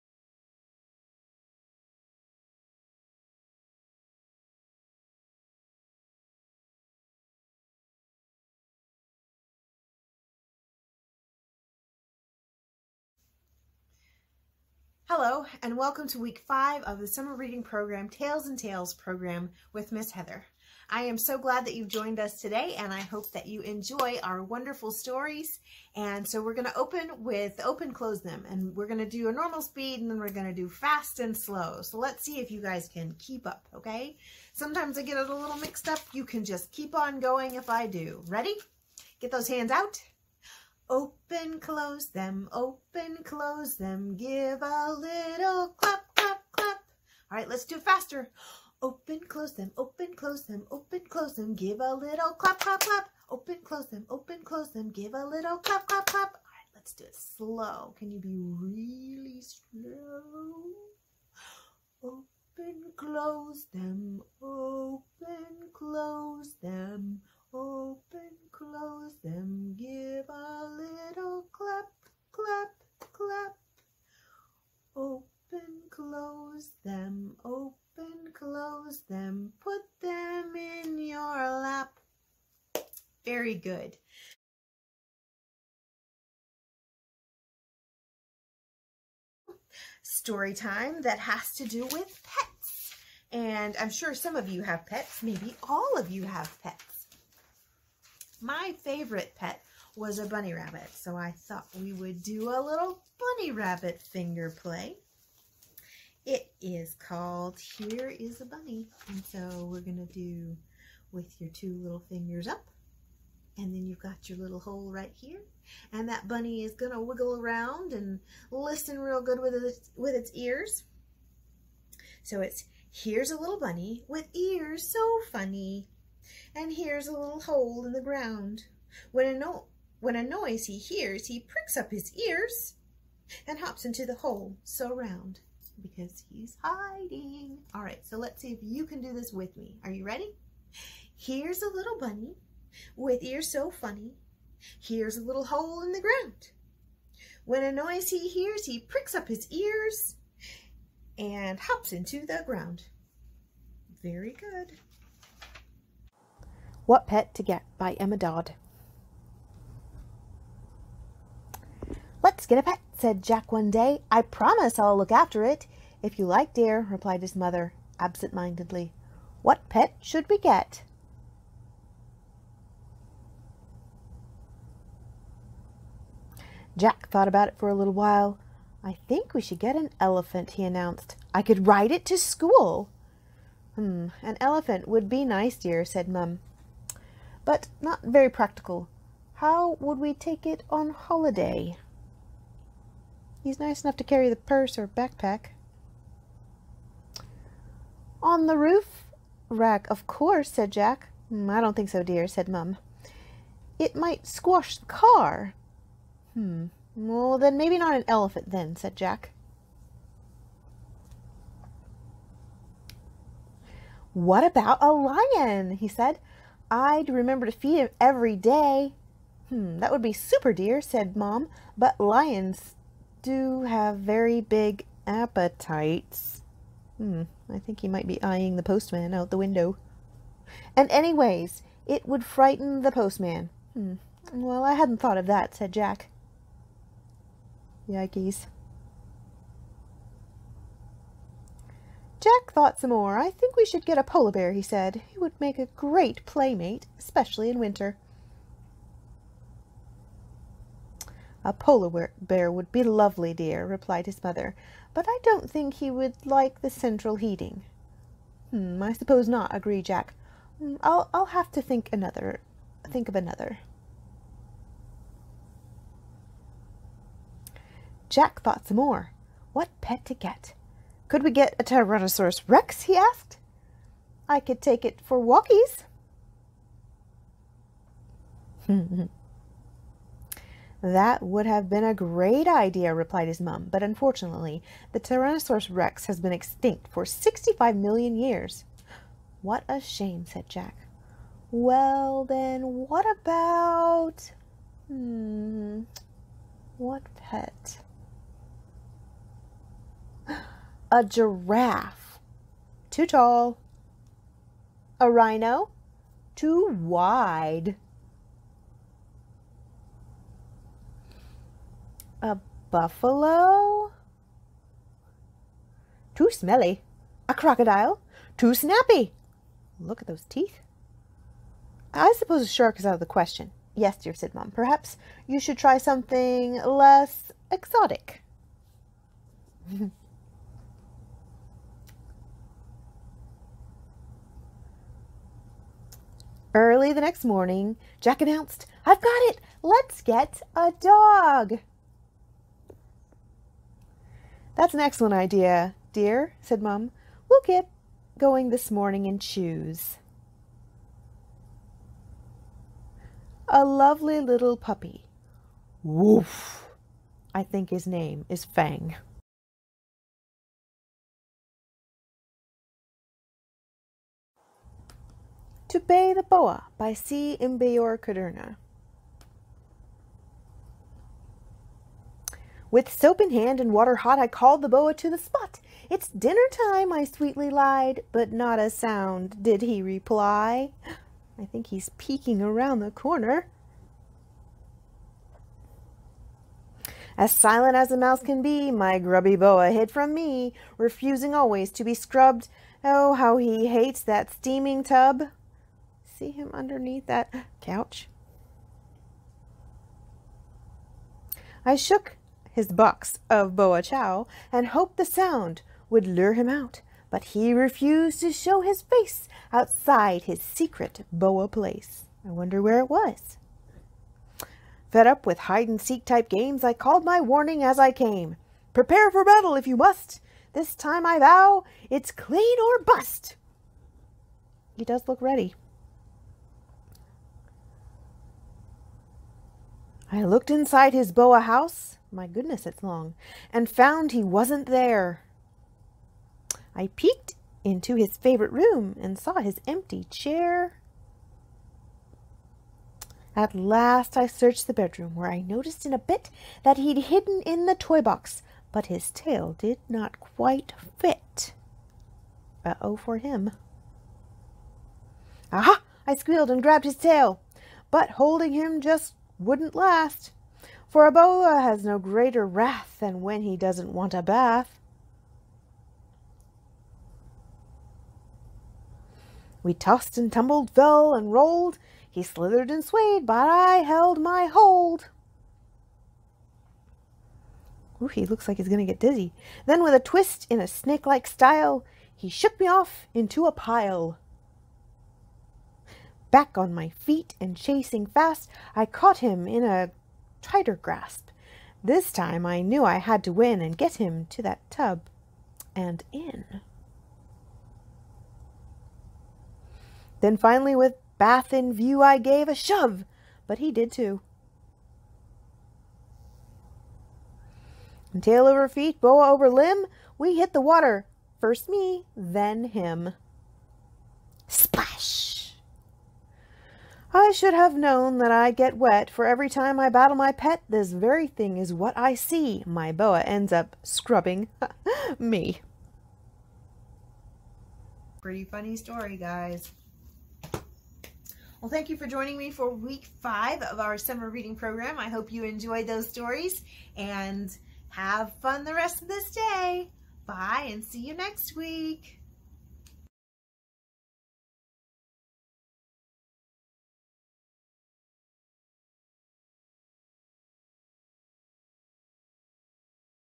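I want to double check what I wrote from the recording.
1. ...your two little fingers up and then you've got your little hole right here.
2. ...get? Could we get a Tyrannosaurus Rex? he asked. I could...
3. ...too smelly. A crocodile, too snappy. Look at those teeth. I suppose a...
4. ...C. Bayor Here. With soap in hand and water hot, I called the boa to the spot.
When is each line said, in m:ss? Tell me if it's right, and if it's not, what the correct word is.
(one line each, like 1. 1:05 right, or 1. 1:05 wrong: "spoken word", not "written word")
1. 1:51 right
2. 4:30 right
3. 5:16 right
4. 6:06 wrong: "Kudrna", not "Here".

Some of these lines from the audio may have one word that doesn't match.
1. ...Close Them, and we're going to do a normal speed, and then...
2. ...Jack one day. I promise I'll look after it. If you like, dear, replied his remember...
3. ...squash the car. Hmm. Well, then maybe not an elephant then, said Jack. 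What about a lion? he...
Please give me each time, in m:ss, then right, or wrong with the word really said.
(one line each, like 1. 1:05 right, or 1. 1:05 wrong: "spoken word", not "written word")
1. 0:27 right
2. 2:43 wrong: "mother", not "remember"
3. 3:24 right.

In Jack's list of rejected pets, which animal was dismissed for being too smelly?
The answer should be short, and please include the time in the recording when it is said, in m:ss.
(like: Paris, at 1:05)
Buffalo, at 5:12.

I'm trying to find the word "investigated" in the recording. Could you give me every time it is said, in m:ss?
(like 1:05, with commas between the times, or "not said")
not said.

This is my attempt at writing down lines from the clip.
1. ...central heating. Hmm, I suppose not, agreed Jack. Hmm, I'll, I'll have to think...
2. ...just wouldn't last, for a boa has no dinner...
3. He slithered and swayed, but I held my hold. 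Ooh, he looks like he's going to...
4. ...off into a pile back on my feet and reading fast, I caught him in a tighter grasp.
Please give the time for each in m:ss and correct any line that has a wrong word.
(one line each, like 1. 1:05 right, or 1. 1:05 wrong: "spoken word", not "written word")
1. 4:16 right
2. 7:38 wrong: "greater", not "dinner"
3. 7:52 right
4. 8:02 wrong: "chasing", not "reading".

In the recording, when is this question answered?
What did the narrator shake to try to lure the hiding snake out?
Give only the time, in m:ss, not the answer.
6:42.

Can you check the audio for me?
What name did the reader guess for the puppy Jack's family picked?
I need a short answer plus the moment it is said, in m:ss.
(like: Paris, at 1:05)
Fang, at 5:58.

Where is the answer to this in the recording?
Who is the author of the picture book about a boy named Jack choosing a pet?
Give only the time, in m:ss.
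2:37.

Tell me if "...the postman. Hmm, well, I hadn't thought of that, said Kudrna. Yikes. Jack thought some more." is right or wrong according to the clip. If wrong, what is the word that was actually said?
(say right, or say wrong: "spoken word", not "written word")
wrong: "Jack", not "Kudrna".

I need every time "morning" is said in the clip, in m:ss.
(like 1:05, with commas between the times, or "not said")
5:37, 5:48.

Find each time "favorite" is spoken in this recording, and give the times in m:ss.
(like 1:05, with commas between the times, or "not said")
1:38, 7:18.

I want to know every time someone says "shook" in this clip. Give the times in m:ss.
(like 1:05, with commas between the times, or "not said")
6:41, 8:02.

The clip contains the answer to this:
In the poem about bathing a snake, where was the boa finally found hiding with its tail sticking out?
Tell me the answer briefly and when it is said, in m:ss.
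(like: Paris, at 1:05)
Toy box, at 7:27.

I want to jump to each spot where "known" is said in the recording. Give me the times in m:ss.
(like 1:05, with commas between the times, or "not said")
8:37.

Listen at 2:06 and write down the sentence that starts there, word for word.
And here's a little hole in the ground.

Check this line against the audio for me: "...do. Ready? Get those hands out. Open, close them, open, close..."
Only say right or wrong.
right.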